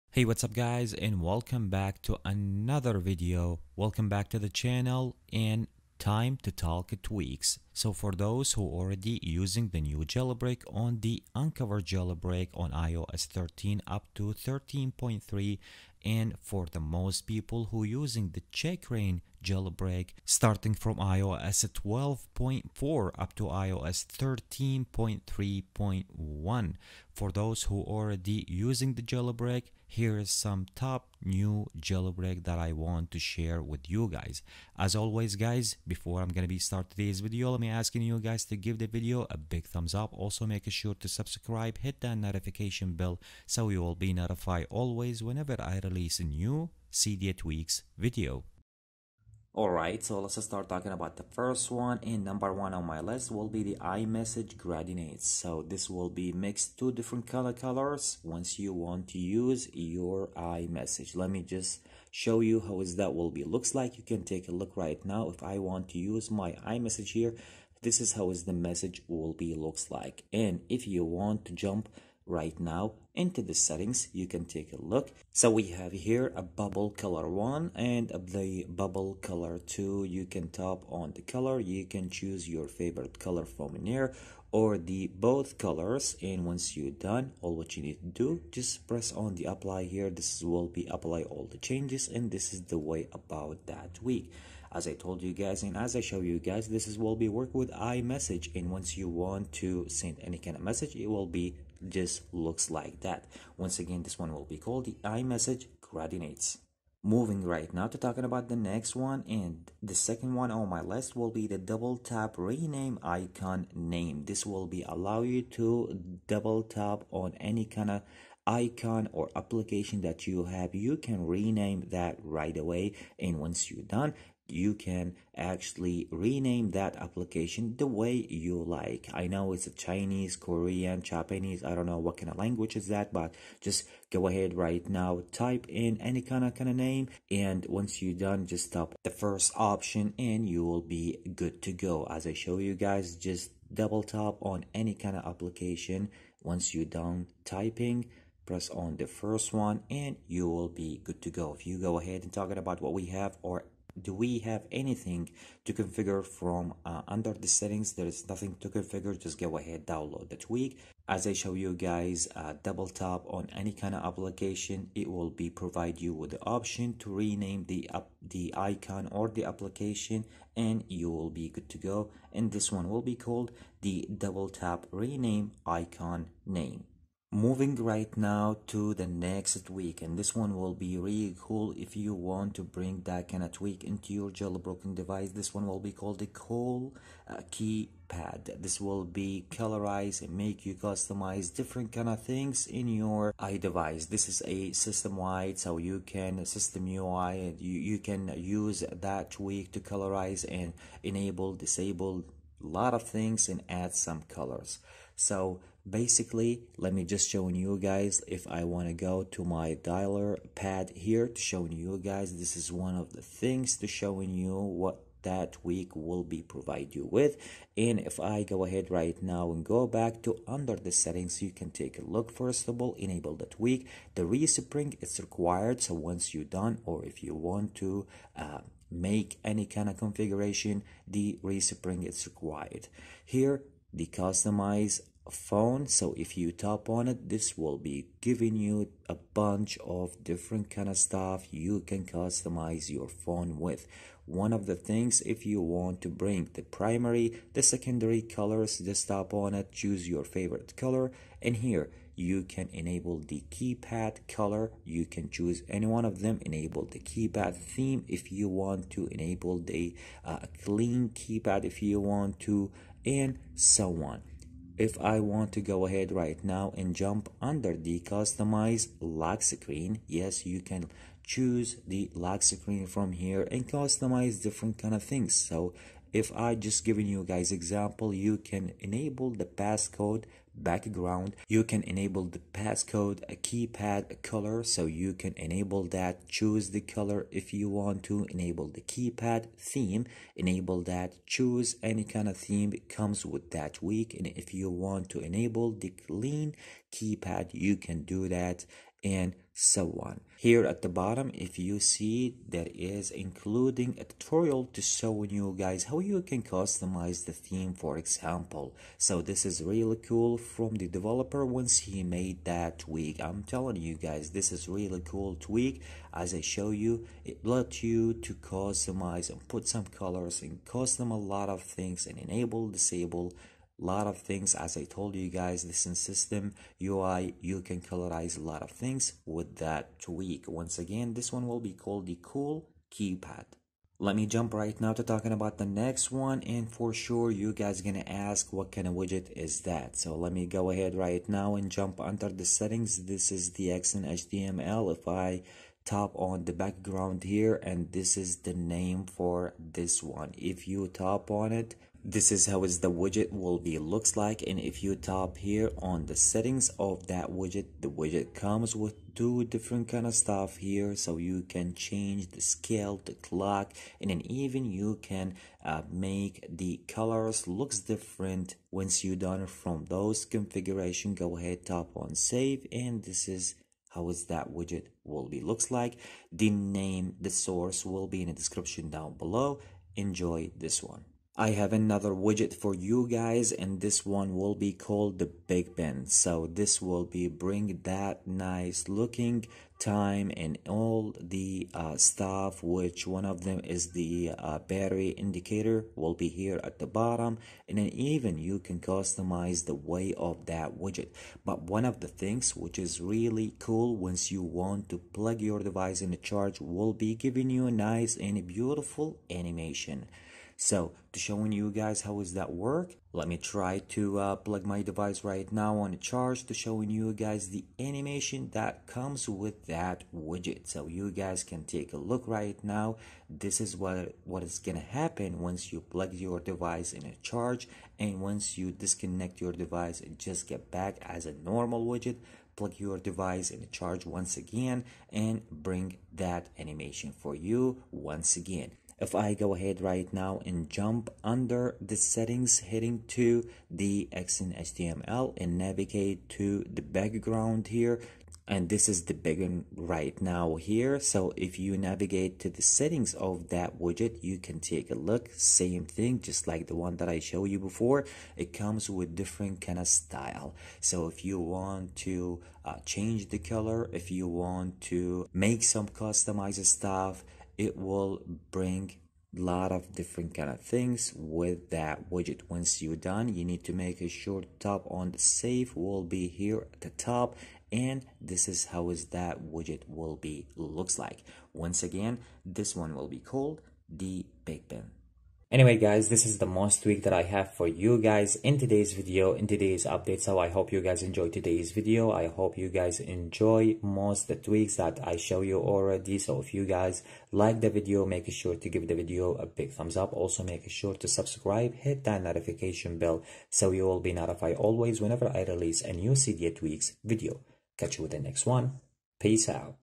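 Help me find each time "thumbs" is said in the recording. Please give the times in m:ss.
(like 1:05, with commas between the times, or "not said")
0:39, 8:19.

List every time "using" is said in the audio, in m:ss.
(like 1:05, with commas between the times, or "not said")
0:09, 0:17, 0:28.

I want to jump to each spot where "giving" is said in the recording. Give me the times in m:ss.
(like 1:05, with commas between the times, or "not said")
3:58, 4:36, 6:47.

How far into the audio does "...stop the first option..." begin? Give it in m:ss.
2:18.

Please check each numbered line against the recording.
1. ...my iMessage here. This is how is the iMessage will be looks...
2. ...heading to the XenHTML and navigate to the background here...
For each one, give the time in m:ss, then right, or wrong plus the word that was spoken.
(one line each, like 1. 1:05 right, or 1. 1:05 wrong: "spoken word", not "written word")
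1. 1:06 wrong: "message", not "iMessage"
2. 7:22 right.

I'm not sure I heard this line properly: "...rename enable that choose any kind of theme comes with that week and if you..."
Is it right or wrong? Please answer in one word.
wrong.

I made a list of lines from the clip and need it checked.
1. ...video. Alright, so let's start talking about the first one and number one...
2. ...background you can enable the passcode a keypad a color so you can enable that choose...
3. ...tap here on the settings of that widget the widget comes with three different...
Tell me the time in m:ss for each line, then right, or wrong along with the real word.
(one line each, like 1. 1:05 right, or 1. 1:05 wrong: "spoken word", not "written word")
1. 0:47 right
2. 4:40 right
3. 5:54 wrong: "two", not "three".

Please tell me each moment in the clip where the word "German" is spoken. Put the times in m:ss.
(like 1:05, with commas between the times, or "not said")
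not said.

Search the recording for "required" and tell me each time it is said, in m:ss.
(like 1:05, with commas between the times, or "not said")
3:45, 3:52.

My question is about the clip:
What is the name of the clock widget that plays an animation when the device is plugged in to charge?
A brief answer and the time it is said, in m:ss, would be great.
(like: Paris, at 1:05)
Big Ben, at 6:25.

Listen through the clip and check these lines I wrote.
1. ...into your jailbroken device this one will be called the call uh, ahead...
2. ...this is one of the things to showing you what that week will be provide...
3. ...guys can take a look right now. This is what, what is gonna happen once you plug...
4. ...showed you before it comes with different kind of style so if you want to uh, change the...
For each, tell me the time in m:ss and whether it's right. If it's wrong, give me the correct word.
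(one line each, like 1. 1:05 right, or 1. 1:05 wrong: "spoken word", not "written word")
1. 3:03 wrong: "keypad", not "ahead"
2. 3:32 right
3. 7:01 right
4. 7:37 right.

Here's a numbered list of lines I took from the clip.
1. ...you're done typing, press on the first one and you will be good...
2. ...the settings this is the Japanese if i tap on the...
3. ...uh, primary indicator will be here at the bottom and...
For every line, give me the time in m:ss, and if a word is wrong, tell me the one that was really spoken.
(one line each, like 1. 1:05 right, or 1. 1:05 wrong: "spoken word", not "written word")
1. 2:26 right
2. 5:42 wrong: "XenHTML", not "Japanese"
3. 6:34 wrong: "battery", not "primary".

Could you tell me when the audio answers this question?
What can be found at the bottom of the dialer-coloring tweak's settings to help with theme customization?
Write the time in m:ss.
5:04.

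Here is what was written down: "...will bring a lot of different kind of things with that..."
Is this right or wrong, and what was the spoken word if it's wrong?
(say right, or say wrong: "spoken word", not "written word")
right.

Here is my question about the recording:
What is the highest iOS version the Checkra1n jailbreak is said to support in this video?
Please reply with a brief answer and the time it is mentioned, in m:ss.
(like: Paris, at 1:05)
iOS 13.3.1, at 0:23.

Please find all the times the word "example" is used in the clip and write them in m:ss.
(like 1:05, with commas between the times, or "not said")
4:37, 5:07.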